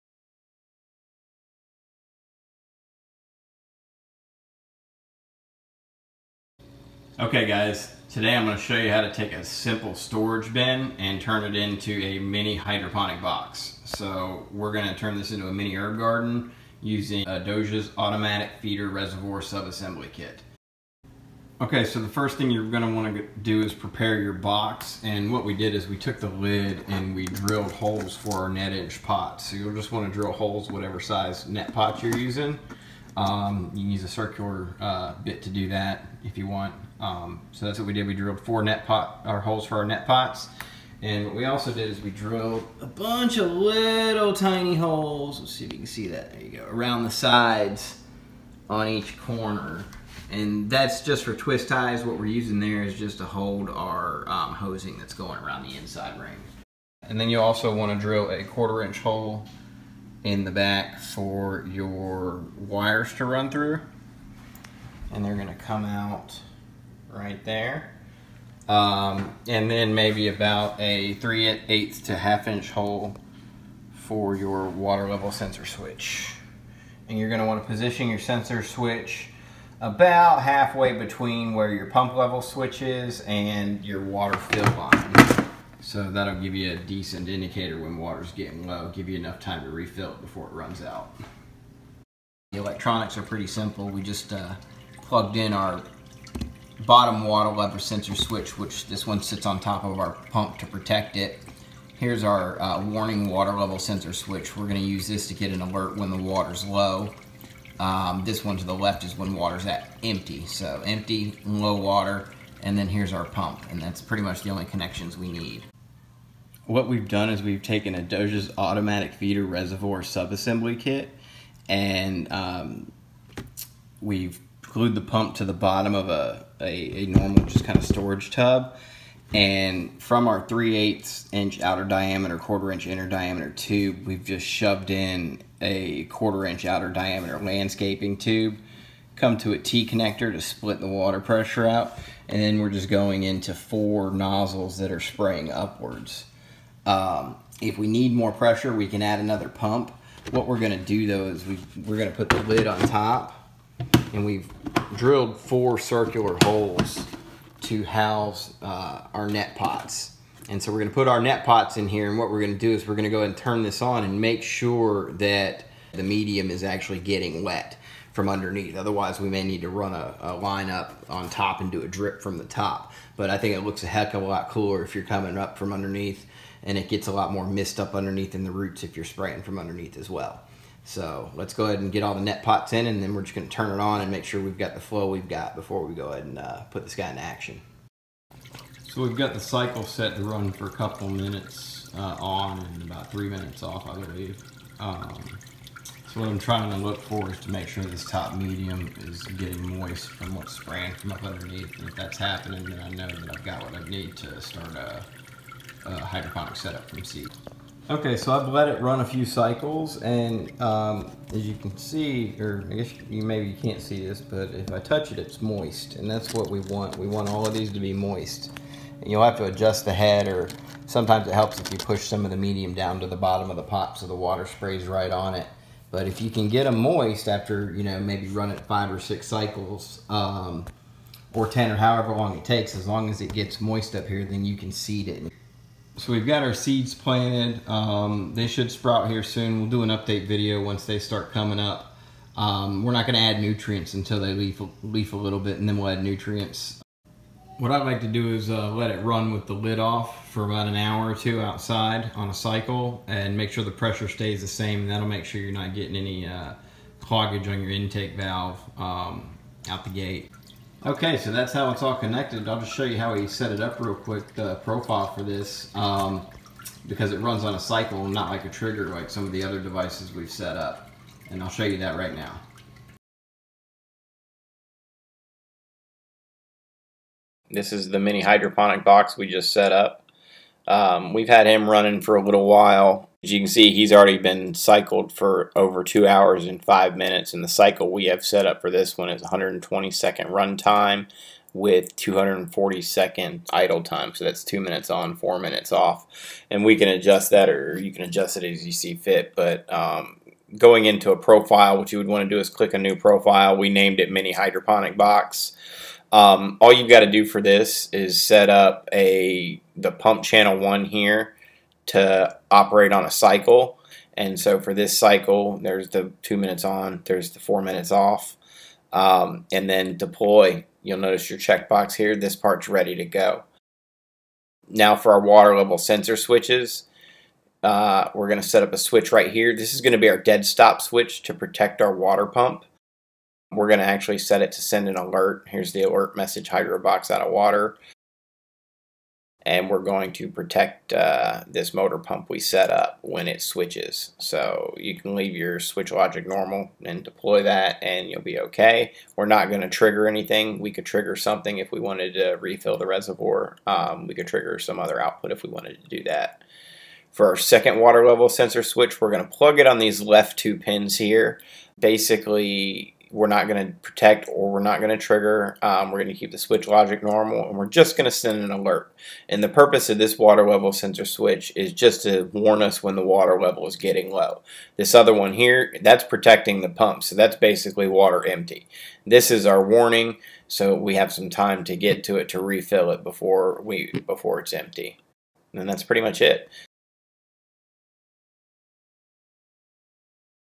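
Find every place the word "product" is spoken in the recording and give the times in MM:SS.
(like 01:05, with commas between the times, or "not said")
not said.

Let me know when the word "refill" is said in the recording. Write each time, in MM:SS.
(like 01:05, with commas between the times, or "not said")
01:29, 05:52, 06:22.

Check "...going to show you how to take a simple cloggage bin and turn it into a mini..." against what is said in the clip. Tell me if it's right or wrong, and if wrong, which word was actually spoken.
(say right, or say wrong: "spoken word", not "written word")
wrong: "storage", not "cloggage".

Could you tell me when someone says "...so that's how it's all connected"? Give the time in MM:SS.
04:21.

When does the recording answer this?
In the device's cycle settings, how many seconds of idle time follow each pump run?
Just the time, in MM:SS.
04:51.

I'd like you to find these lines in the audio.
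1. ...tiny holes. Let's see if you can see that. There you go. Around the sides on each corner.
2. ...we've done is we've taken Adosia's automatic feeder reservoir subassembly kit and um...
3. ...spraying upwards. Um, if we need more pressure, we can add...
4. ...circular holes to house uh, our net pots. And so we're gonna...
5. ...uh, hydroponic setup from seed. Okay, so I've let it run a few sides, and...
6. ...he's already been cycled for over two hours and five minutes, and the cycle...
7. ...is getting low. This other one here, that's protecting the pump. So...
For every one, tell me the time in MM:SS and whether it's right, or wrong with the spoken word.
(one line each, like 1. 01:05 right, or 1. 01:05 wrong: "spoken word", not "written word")
1. 00:44 right
2. 01:56 right
3. 02:24 right
4. 02:35 right
5. 03:25 wrong: "cycles", not "sides"
6. 04:43 right
7. 06:13 right.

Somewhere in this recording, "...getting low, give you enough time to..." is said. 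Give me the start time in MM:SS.
01:28.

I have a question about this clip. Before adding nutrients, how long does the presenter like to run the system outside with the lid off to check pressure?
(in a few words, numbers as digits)
an hour or two.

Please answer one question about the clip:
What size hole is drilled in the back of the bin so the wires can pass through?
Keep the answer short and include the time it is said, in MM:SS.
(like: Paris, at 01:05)
1/4 inch, at 00:58.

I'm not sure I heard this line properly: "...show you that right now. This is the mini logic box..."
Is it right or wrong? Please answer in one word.
wrong.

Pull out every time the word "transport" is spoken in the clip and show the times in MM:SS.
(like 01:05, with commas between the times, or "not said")
not said.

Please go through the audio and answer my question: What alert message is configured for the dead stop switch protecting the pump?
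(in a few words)
hydro box out of water.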